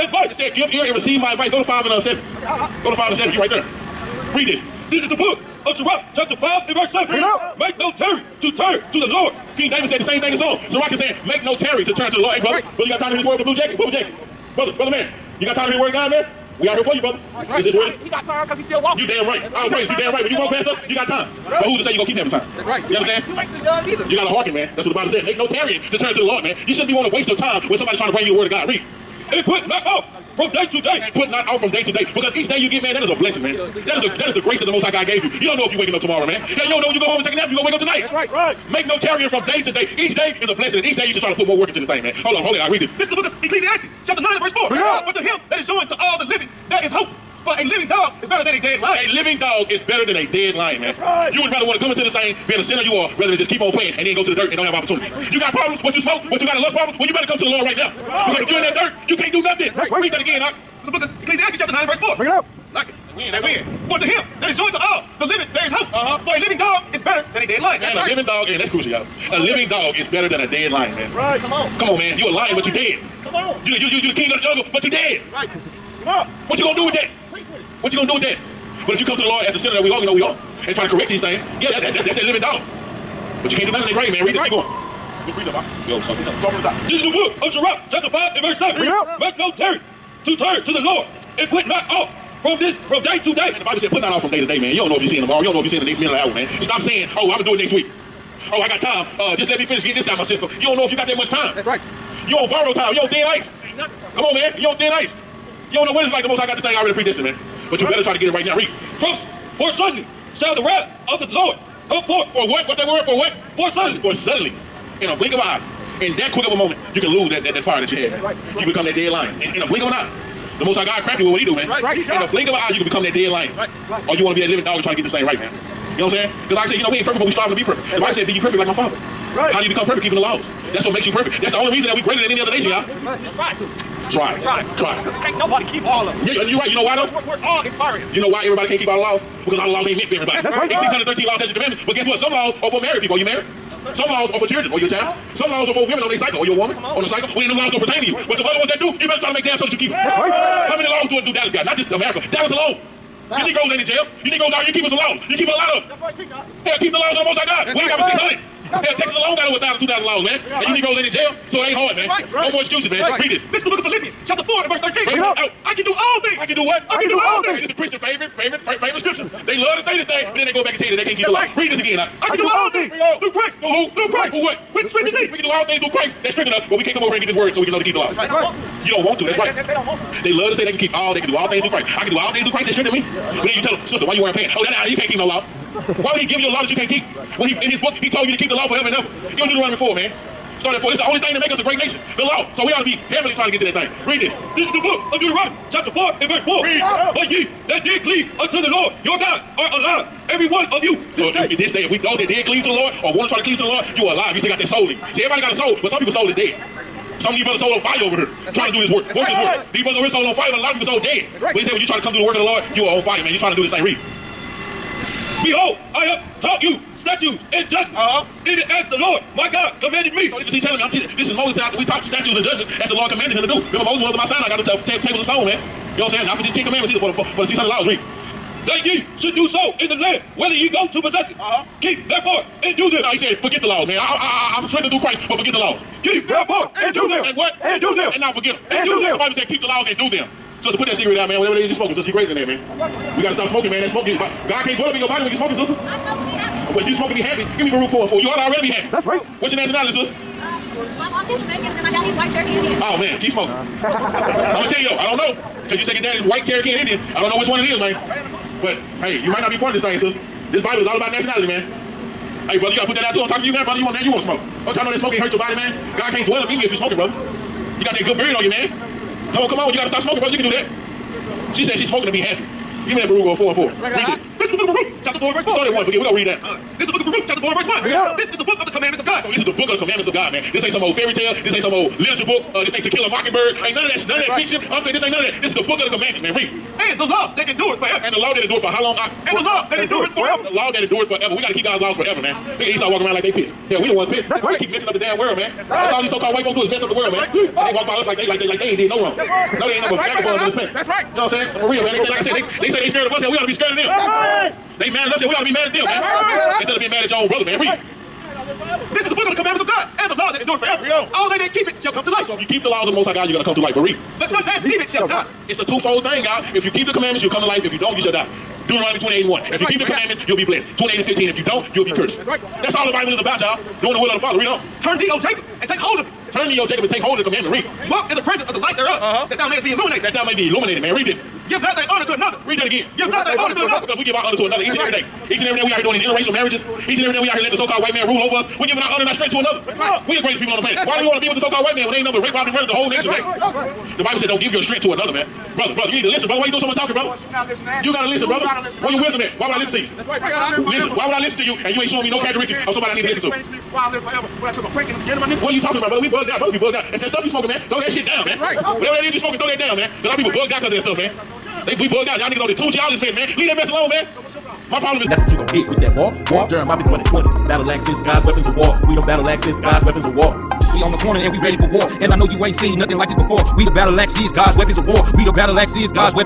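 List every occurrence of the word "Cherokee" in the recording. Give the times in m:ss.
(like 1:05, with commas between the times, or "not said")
4:12, 4:16.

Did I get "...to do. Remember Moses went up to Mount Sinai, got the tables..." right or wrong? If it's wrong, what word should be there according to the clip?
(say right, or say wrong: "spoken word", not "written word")
right.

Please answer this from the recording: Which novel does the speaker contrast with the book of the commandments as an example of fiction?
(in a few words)
To Kill a Mockingbird.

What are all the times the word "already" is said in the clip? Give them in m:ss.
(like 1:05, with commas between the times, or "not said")
1:46, 4:08.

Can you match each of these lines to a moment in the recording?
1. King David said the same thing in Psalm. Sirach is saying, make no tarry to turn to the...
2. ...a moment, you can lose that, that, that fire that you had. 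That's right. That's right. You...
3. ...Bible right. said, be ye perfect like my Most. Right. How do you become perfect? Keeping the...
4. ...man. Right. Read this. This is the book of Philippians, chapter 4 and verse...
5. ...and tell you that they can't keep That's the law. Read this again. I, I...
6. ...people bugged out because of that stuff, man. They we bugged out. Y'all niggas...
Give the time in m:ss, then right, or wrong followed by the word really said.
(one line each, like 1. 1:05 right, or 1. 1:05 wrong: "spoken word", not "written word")
1. 0:09 right
2. 1:56 right
3. 2:08 wrong: "Father", not "Most"
4. 2:42 right
5. 2:50 right
6. 6:00 right.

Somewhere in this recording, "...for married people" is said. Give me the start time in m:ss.
2:22.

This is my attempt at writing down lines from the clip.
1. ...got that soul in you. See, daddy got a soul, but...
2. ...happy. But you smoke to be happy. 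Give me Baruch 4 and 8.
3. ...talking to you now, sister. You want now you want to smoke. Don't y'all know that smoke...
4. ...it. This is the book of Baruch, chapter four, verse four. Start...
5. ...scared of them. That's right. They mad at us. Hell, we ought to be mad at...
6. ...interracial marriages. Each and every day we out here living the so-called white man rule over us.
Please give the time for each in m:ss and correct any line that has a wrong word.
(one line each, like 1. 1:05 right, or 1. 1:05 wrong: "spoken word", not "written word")
1. 3:24 wrong: "everybody", not "daddy"
2. 4:06 wrong: "4", not "8"
3. 4:23 wrong: "brother", not "sister"
4. 4:34 right
5. 5:03 right
6. 5:36 wrong: "letting", not "living".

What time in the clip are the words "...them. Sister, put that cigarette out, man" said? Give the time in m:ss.
4:00.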